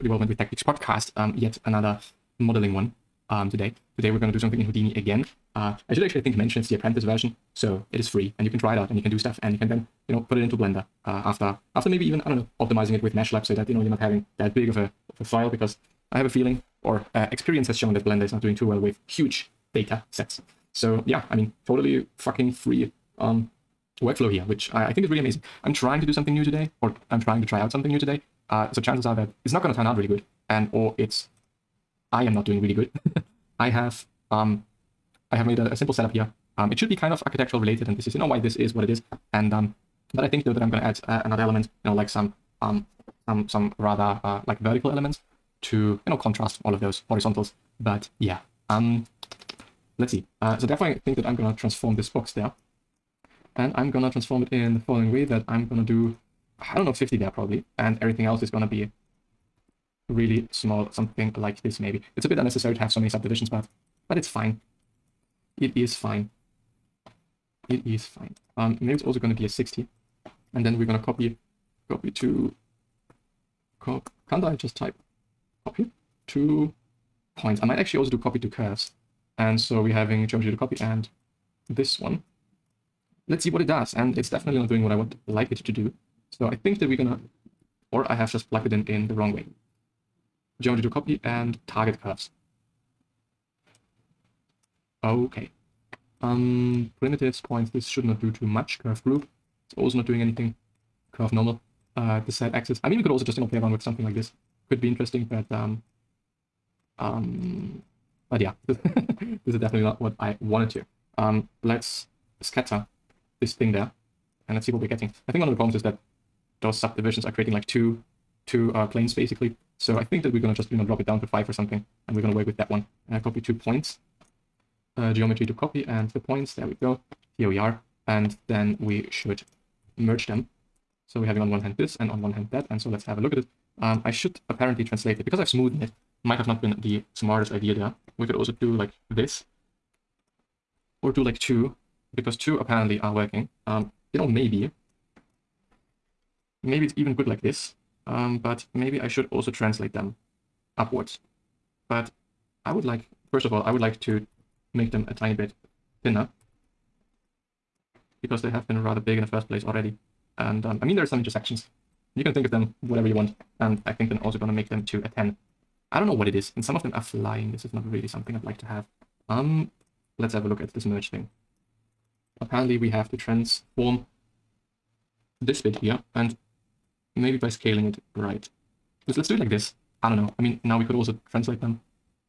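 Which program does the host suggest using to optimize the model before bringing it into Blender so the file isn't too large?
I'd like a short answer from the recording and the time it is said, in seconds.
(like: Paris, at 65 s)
MeshLab, at 13 s.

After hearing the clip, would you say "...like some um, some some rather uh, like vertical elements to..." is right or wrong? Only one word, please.
right.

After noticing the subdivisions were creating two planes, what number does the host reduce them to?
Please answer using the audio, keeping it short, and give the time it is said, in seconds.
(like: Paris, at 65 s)
5, at 121 s.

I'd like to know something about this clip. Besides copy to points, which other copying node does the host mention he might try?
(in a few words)
copy to curves.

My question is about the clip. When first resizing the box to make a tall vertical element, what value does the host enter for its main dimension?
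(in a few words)
50.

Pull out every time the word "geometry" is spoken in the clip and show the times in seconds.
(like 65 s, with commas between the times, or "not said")
80 s, 90 s, 125 s.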